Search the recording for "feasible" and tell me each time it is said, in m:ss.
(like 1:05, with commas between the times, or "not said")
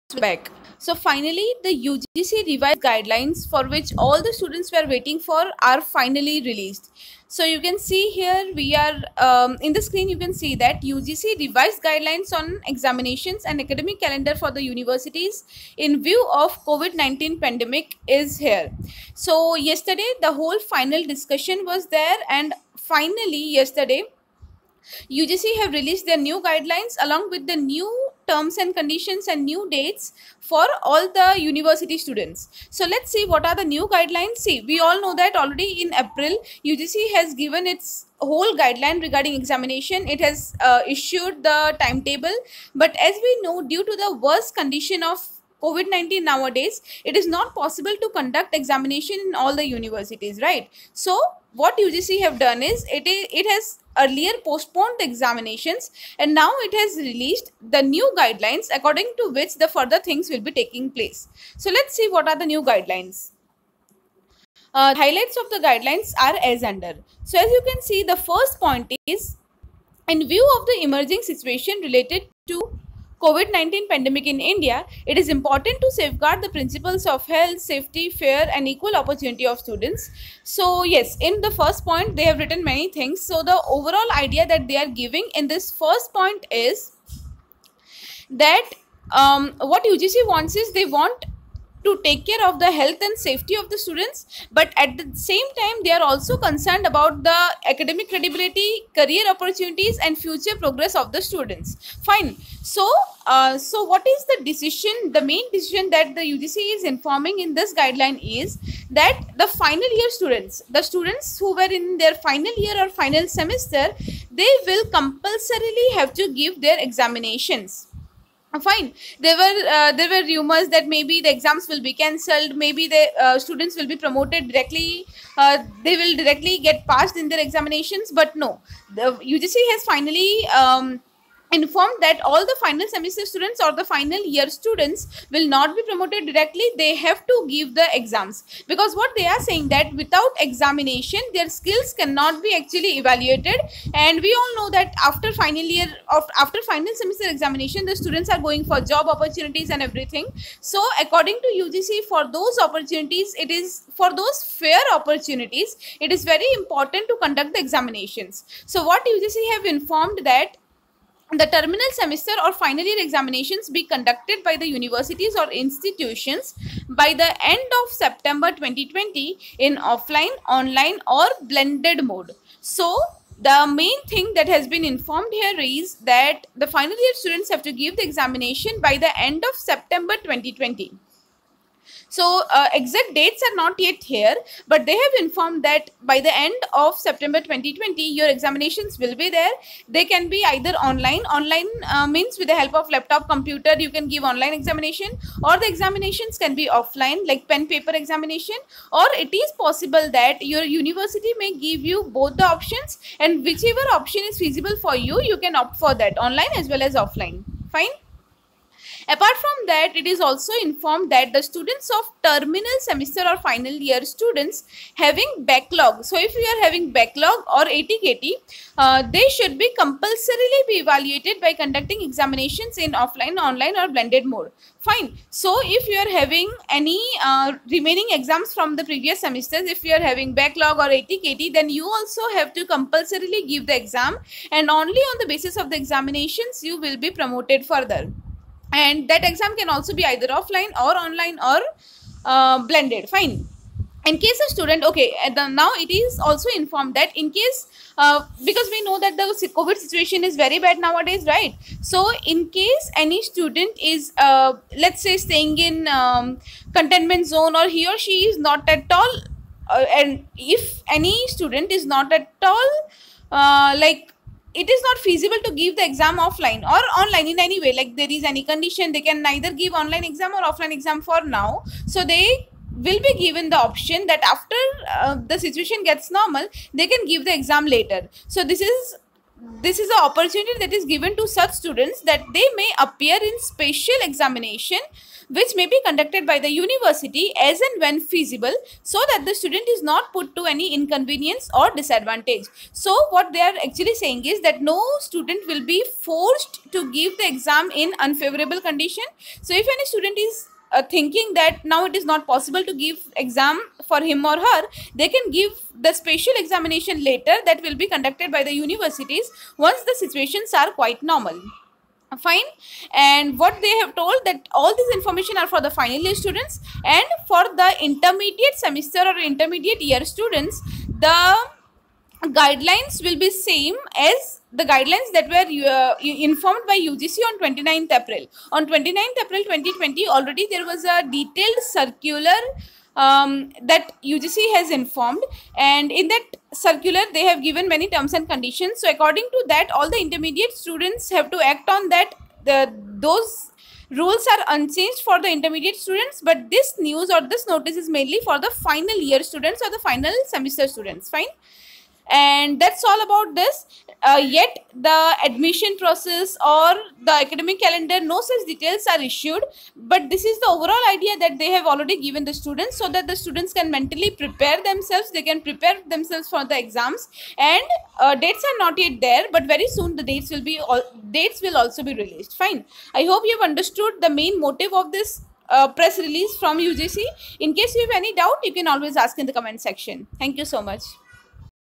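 3:24, 4:24, 4:48.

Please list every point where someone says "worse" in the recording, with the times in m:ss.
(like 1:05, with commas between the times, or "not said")
0:44.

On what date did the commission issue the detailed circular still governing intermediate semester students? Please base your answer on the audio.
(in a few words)
29th April 2020.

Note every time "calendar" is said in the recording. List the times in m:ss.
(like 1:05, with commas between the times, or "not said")
0:14, 5:57.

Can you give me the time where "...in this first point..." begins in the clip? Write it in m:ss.
1:25.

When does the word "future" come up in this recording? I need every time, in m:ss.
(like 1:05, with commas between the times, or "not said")
1:40.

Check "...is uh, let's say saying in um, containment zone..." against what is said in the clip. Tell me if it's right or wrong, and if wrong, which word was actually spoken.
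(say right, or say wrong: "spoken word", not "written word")
wrong: "staying", not "saying".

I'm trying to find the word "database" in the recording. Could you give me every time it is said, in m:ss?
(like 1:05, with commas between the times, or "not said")
not said.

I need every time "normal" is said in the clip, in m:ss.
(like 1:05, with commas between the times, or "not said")
4:36, 5:11.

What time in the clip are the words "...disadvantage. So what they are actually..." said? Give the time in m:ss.
4:51.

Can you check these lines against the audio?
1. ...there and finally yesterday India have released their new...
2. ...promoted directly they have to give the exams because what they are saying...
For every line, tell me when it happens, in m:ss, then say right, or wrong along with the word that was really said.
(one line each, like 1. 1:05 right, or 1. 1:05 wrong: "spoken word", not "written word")
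1. 0:21 wrong: "UGC", not "India"
2. 2:15 right.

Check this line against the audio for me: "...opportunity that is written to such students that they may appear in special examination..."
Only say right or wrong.
wrong.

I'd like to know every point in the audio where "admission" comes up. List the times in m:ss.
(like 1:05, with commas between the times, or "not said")
5:55.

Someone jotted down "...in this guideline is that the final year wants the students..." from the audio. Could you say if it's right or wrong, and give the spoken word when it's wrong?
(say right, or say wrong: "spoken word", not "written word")
wrong: "students", not "wants".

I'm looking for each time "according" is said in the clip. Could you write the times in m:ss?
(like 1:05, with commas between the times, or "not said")
0:58, 2:31, 5:38.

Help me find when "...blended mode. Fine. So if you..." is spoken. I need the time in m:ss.
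3:43.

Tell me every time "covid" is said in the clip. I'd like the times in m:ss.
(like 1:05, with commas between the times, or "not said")
0:16, 0:45, 1:13, 4:09.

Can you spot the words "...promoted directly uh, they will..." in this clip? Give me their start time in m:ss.
2:03.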